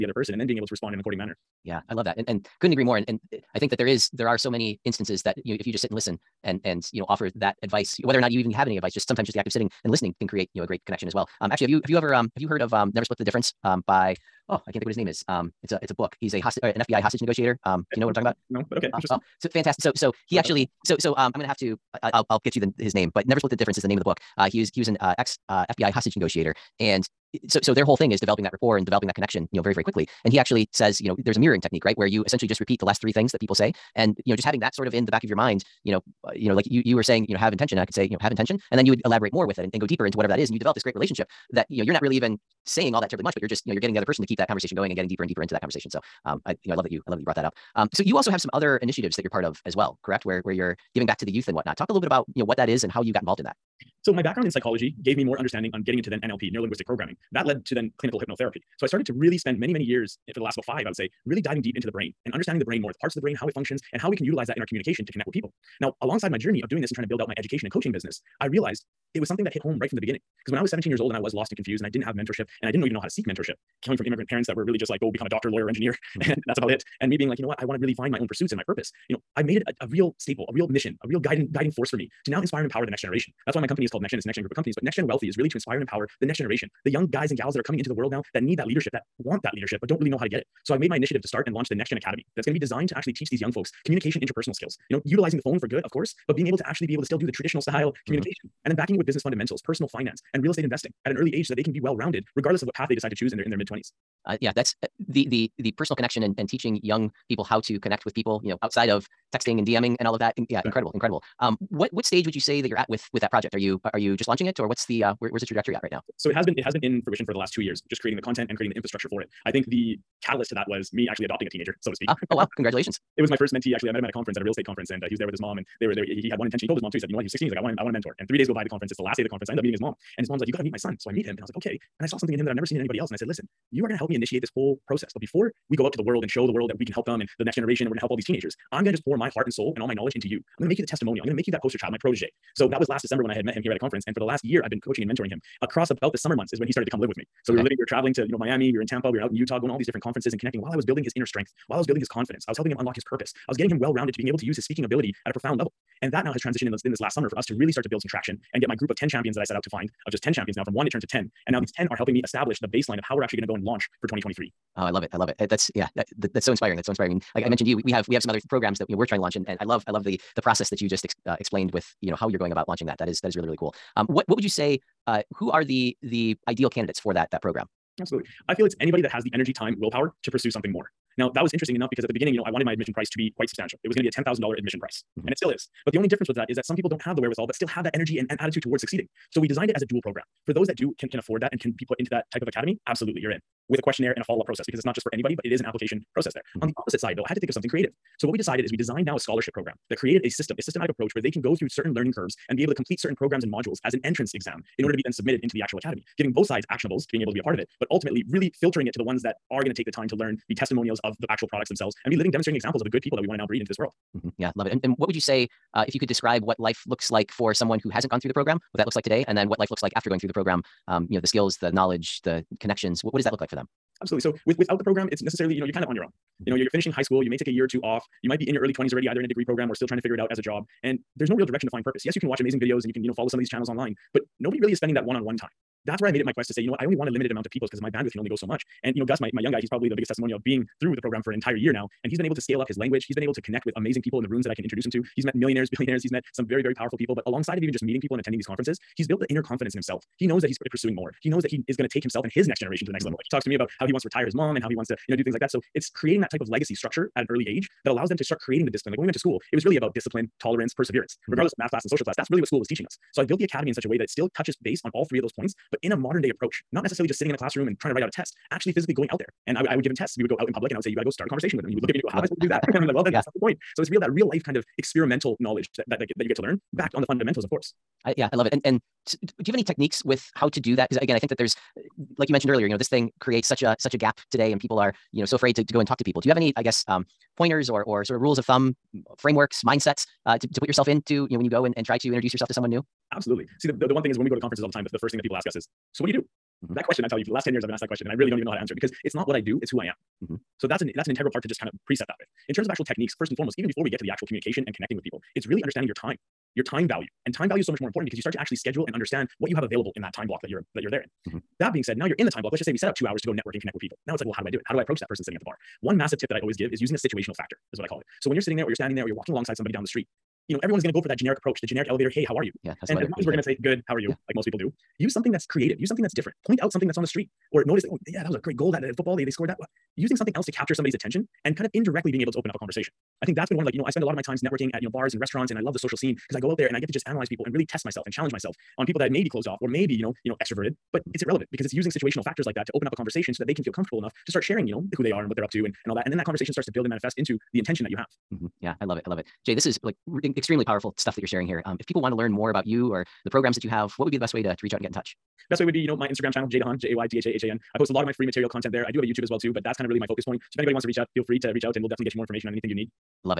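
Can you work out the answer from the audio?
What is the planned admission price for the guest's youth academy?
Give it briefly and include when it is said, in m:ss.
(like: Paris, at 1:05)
$10,000, at 3:04.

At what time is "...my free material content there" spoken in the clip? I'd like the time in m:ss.
5:58.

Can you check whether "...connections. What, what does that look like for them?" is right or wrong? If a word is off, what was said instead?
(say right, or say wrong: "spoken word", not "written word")
right.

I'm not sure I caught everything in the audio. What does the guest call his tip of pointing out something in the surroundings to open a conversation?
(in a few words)
situational factor.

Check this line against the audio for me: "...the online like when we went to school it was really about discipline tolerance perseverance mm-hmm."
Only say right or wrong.
wrong.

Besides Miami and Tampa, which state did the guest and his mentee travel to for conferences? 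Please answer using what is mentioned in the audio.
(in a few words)
Utah.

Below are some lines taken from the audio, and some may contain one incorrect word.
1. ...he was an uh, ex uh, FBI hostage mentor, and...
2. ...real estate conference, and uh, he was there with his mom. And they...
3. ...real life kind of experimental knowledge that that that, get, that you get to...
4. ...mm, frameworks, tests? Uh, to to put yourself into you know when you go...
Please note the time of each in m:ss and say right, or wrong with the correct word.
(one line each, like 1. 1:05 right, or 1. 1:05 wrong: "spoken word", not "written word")
1. 0:24 wrong: "negotiator", not "mentor"
2. 2:04 right
3. 4:34 right
4. 4:48 wrong: "mindsets", not "tests".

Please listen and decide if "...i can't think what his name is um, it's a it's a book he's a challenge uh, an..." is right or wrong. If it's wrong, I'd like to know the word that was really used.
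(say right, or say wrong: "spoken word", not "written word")
wrong: "hostage", not "challenge".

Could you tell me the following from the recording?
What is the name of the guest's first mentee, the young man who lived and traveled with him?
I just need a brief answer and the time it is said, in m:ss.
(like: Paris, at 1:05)
Gus, at 3:59.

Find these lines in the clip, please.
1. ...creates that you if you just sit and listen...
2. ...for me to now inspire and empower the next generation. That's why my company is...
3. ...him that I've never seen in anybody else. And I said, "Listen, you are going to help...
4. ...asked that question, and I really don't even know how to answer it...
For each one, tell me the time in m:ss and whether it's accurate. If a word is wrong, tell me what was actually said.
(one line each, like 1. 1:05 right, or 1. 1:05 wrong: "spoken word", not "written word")
1. 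0:04 wrong: "instances", not "creates"
2. 1:21 right
3. 2:12 right
4. 4:57 right.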